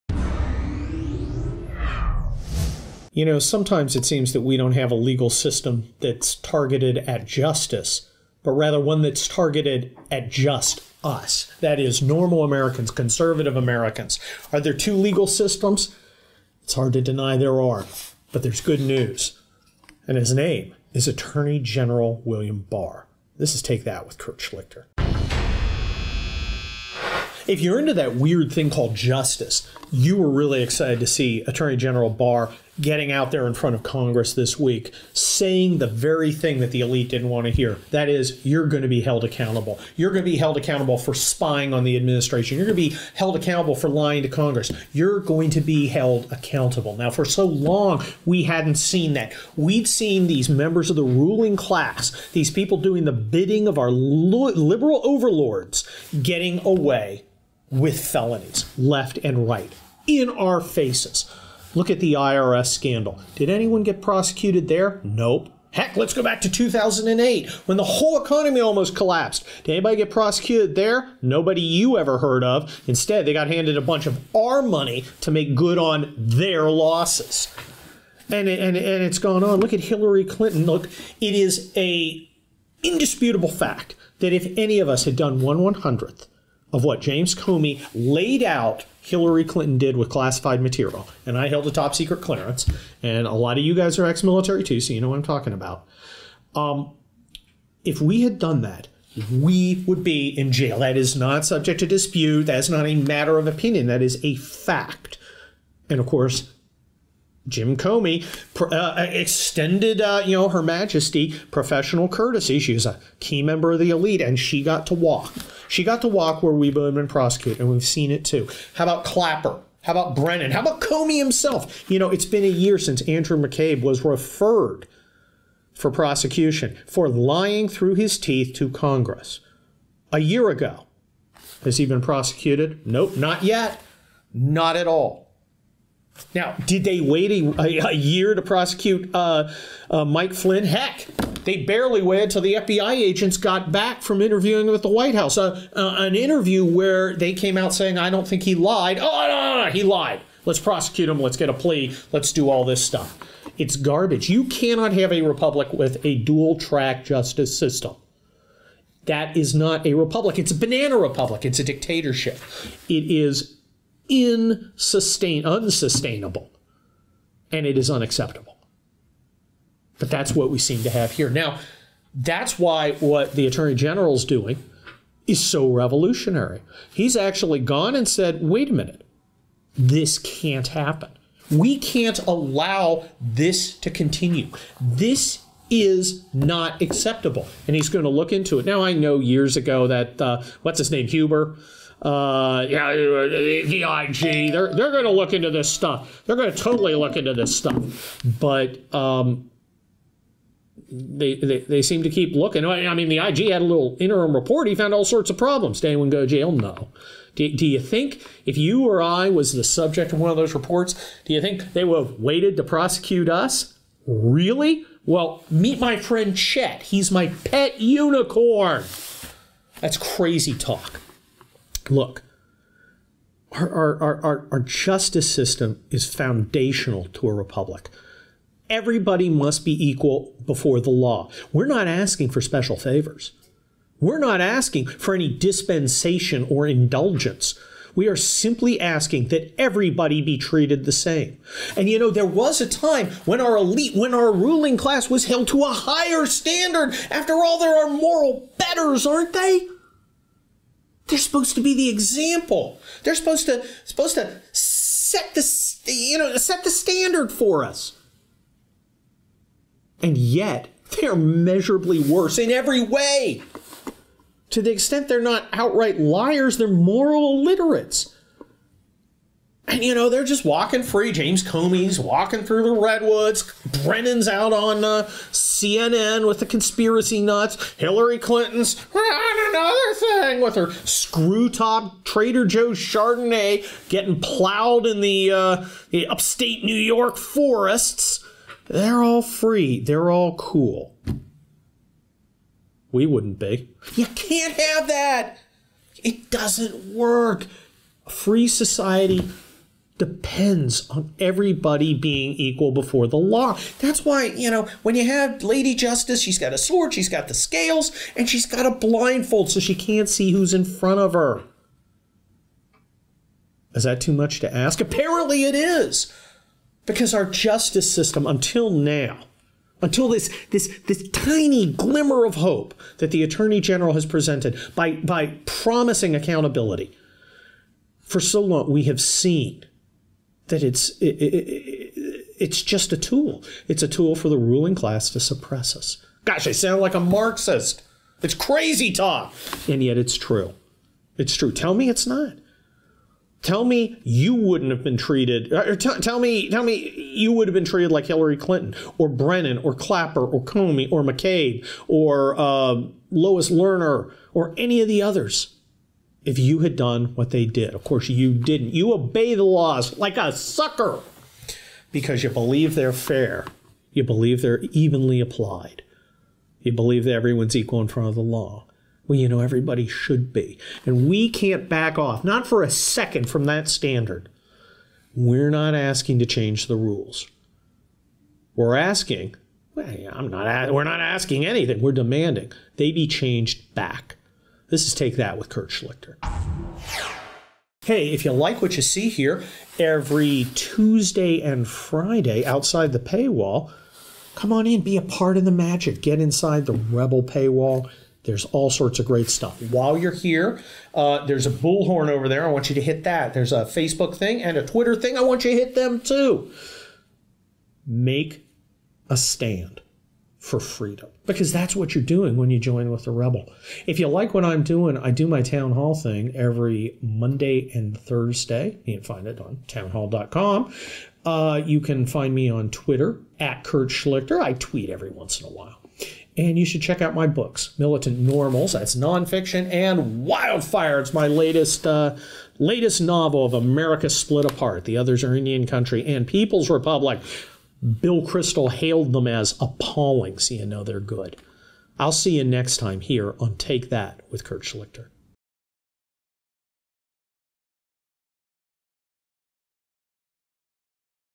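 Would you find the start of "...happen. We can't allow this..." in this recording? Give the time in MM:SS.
03:00.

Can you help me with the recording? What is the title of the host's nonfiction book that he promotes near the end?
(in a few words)
Militant Normals.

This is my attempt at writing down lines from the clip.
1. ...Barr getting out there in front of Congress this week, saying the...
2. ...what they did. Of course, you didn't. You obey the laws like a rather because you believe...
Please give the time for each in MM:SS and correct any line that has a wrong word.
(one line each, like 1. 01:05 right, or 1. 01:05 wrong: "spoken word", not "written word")
1. 00:32 right
2. 05:57 wrong: "sucker", not "rather".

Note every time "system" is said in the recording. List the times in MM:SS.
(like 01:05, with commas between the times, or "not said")
00:05, 00:15, 02:37, 03:45, 05:17.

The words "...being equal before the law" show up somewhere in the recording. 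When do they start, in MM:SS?
05:01.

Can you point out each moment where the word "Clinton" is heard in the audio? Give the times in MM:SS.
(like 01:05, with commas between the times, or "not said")
01:20, 01:29, 04:38, 05:48.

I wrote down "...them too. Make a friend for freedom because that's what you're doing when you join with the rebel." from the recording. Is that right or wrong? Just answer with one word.
wrong.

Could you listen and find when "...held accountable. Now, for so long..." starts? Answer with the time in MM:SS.
00:45.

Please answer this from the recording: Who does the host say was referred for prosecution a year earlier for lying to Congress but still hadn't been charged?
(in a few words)
Andrew McCabe.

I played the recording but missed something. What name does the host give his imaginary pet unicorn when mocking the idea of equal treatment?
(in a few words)
Chet.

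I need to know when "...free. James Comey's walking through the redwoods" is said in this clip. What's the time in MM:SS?
04:30.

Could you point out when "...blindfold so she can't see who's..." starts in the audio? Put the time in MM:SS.
05:08.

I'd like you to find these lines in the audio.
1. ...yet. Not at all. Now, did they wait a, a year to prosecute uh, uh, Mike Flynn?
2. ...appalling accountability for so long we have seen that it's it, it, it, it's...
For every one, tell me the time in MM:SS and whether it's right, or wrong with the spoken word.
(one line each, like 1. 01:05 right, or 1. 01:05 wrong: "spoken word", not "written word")
1. 02:13 right
2. 05:25 wrong: "promising", not "appalling".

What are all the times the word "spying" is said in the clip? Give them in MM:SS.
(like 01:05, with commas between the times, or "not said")
00:41.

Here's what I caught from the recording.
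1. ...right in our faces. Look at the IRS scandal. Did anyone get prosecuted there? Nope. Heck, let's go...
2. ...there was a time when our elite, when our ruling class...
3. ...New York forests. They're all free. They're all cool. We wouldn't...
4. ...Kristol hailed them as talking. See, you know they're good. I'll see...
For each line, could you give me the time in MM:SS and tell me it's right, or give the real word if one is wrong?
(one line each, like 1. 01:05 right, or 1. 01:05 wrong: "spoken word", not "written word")
1. 00:59 right
2. 04:02 right
3. 04:46 right
4. 07:18 wrong: "appalling", not "talking".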